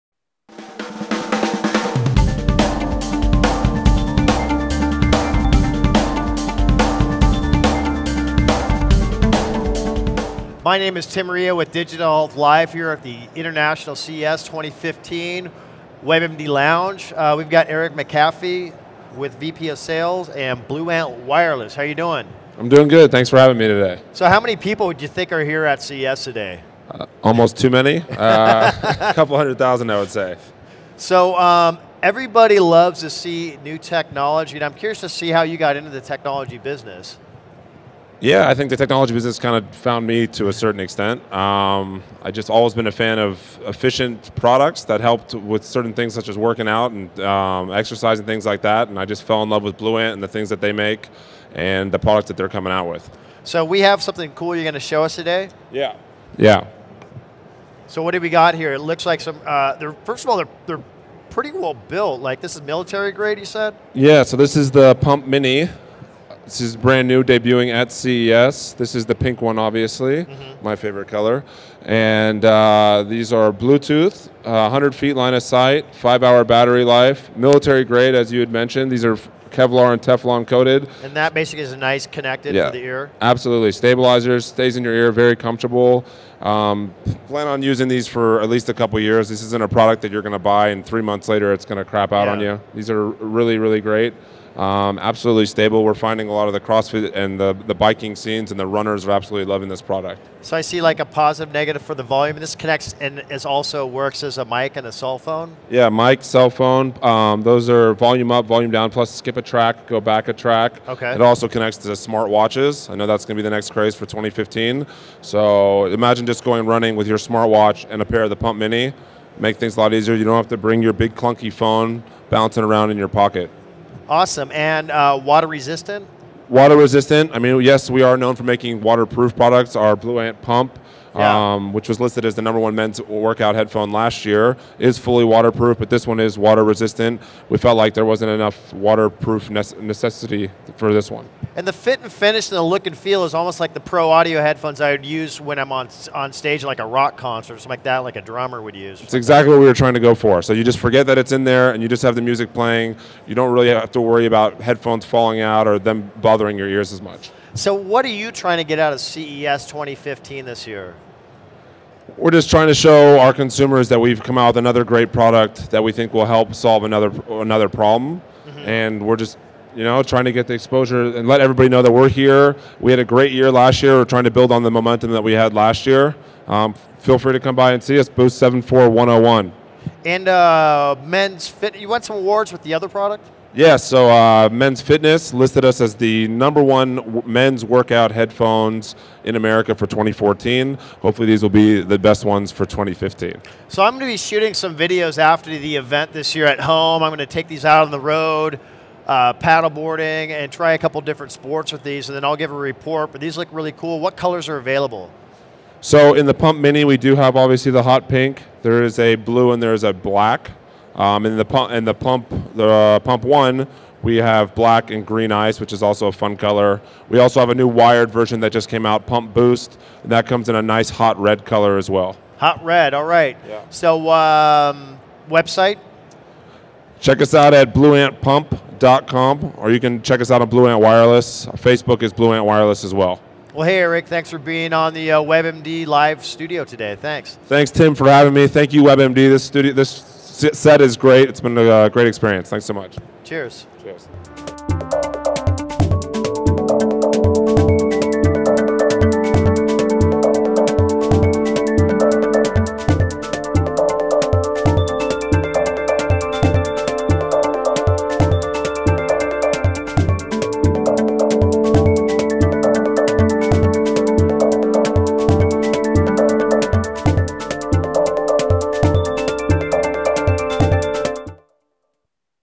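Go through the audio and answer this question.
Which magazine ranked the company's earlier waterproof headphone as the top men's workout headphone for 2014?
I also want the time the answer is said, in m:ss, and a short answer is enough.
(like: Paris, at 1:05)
Men's Fitness, at 3:04.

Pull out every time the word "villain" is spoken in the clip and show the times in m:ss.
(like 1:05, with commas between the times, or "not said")
not said.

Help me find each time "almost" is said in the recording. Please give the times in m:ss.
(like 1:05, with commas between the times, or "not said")
0:27, 2:23.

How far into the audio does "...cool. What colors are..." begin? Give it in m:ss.
3:23.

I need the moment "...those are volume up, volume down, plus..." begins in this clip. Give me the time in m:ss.
1:47.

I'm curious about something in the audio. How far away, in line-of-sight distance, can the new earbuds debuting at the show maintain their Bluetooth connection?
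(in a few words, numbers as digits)
100 feet.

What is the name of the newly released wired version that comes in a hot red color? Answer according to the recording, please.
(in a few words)
Pump Boost.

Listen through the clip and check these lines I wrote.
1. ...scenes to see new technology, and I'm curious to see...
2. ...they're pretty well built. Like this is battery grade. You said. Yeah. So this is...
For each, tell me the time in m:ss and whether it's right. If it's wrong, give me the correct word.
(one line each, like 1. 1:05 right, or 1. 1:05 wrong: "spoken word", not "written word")
1. 0:32 wrong: "loves", not "scenes"
2. 1:00 wrong: "military", not "battery".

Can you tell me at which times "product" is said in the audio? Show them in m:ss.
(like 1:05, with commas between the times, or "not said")
0:44, 0:51, 1:29, 1:39, 2:09, 2:45, 3:02.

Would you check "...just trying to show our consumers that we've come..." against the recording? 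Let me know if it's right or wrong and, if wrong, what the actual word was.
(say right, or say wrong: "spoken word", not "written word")
right.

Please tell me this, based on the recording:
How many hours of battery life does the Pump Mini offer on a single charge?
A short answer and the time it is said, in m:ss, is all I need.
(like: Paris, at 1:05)
5 hours, at 1:15.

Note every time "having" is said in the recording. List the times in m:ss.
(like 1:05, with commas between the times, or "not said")
0:23, 3:58.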